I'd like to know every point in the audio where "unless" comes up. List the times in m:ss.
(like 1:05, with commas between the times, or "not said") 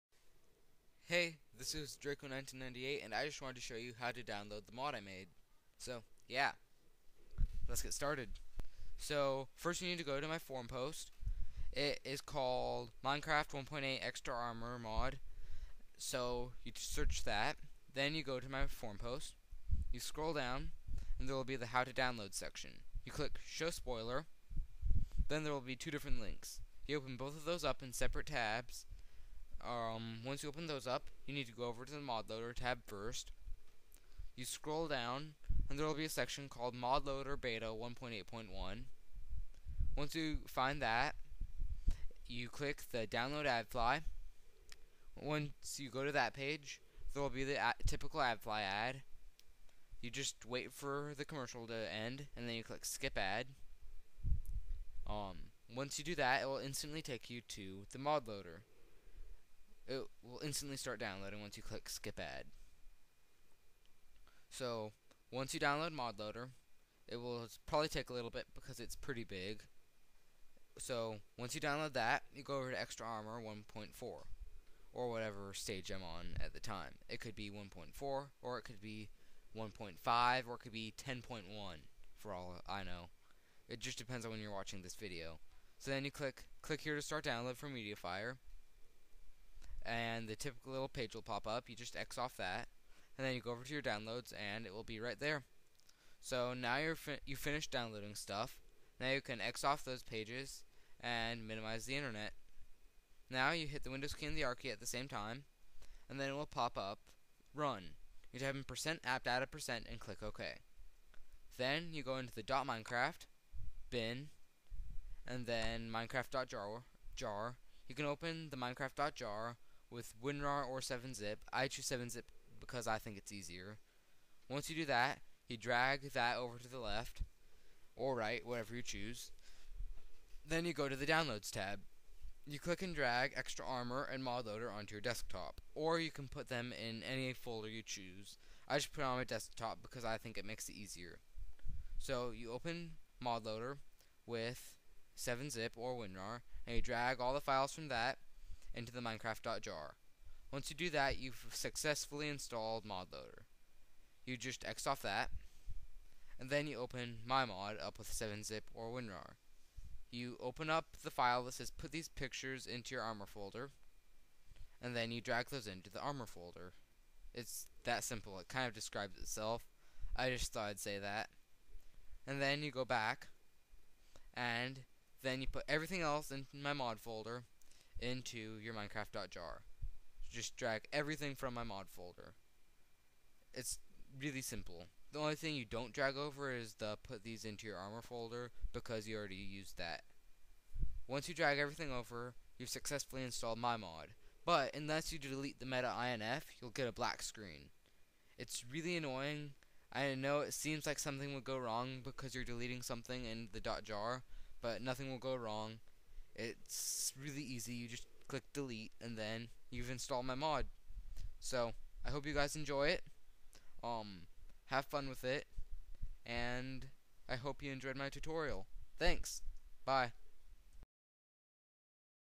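3:14.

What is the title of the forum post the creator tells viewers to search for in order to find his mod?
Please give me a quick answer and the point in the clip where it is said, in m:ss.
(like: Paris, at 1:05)
Minecraft 1.8 Extra Armor Mod, at 0:13.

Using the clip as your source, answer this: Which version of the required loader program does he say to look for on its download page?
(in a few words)
ModLoader beta 1.8.1.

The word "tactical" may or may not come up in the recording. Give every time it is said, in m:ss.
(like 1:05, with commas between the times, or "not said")
not said.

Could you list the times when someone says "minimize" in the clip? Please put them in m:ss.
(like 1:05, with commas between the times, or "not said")
1:41.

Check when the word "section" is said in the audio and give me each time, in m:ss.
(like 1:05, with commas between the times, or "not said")
0:22, 0:36.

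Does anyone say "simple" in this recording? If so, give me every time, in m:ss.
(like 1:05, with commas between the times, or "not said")
2:48, 3:04.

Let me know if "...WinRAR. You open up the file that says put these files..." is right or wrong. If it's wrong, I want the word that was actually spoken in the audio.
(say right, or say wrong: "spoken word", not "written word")
wrong: "pictures", not "files".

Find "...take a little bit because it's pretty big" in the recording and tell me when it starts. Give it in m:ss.
1:07.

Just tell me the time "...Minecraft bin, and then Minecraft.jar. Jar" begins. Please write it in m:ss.
1:52.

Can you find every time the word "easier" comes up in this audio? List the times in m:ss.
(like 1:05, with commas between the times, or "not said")
2:03, 2:20.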